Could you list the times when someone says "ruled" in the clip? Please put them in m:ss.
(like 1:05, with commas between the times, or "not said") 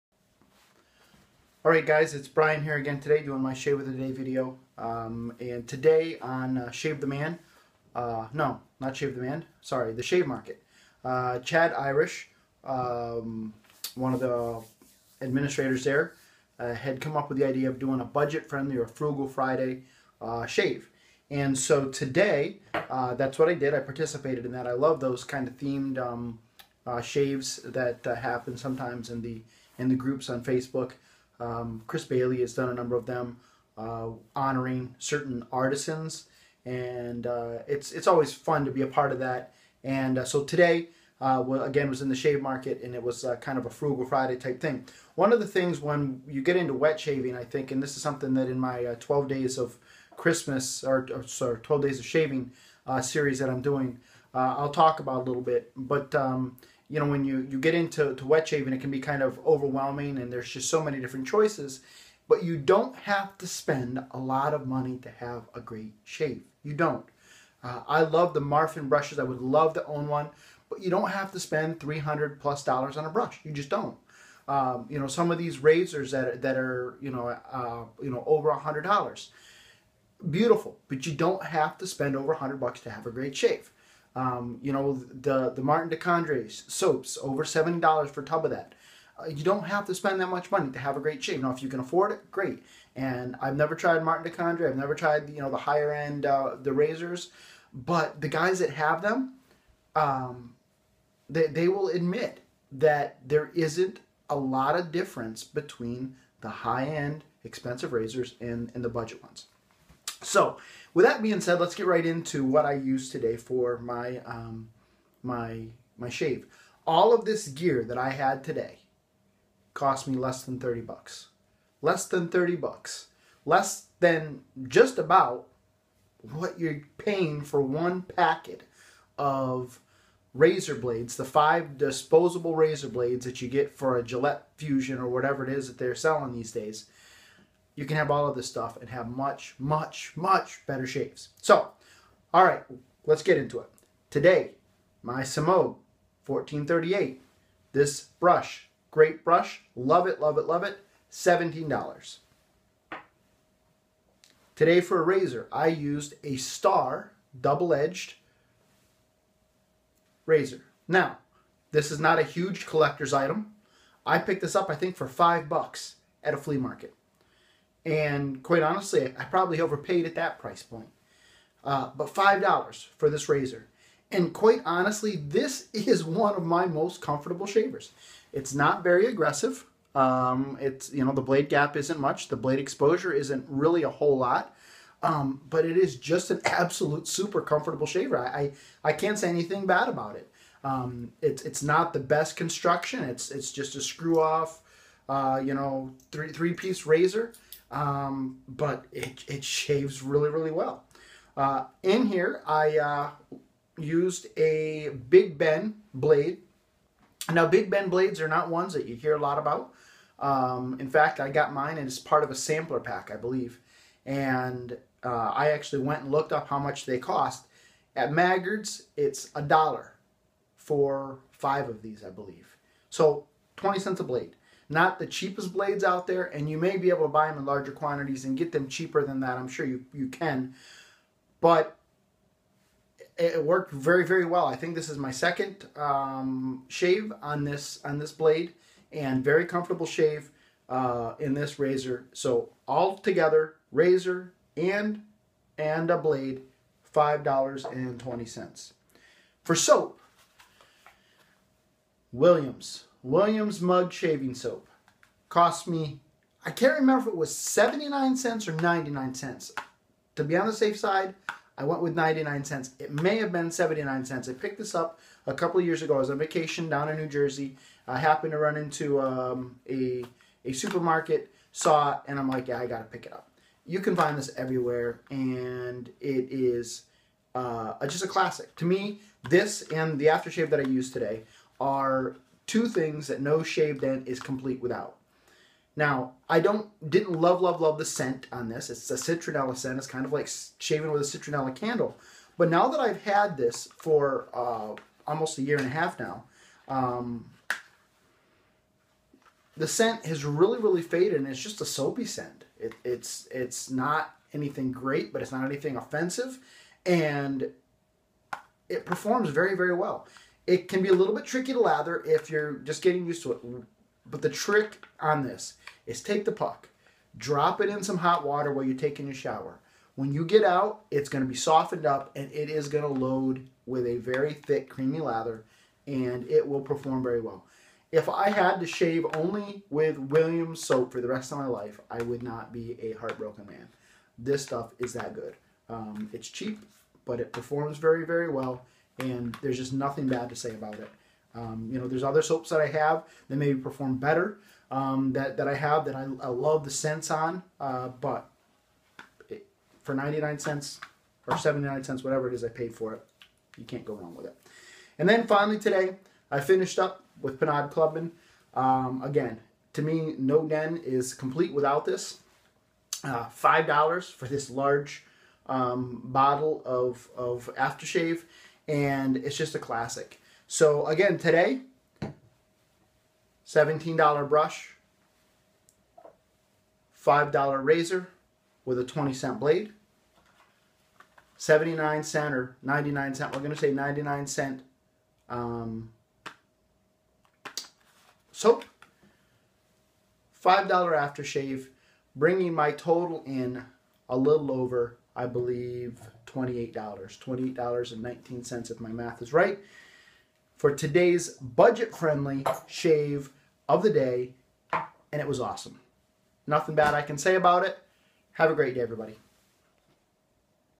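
not said.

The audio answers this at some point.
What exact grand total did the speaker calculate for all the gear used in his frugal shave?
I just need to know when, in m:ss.
6:36.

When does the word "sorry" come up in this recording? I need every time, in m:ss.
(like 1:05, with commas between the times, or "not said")
0:09, 0:51.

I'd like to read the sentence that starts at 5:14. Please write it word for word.
But the trick on this is take the puck, drop it in some hot water while you're taking your shower.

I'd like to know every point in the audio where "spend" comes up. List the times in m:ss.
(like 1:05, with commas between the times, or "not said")
1:03, 1:11, 1:21, 1:29.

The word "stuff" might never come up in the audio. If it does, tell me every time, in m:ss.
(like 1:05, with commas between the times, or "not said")
2:18, 5:34.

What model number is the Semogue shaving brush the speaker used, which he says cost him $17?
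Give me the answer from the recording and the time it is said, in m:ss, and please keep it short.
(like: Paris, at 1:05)
1438, at 2:26.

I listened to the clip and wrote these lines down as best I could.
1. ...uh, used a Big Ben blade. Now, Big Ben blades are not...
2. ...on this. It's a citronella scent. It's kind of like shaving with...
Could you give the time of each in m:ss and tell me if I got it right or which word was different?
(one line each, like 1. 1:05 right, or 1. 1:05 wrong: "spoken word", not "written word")
1. 3:22 right
2. 4:48 right.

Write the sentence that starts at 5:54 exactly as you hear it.
And then finally today, I finished up with Pinaud Clubman.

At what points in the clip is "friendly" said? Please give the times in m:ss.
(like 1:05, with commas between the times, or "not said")
0:18, 6:41.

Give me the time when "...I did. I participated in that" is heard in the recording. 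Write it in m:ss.
0:23.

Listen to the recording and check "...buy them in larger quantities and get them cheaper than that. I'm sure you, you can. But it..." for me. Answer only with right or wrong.
right.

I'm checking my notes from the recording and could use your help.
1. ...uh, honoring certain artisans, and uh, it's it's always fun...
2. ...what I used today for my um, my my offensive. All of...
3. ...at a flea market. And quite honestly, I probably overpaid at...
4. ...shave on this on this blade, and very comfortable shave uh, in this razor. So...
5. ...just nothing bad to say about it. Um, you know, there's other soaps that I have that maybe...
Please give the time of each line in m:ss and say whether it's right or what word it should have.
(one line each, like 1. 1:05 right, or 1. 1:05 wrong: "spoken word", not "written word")
1. 0:33 right
2. 1:52 wrong: "shave", not "offensive"
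3. 2:46 right
4. 3:56 right
5. 5:39 right.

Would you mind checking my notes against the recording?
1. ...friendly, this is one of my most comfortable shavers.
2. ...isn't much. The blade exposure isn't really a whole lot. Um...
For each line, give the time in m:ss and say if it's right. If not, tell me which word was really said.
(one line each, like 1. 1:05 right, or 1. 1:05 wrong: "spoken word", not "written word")
1. 2:54 wrong: "honestly", not "friendly"
2. 3:01 right.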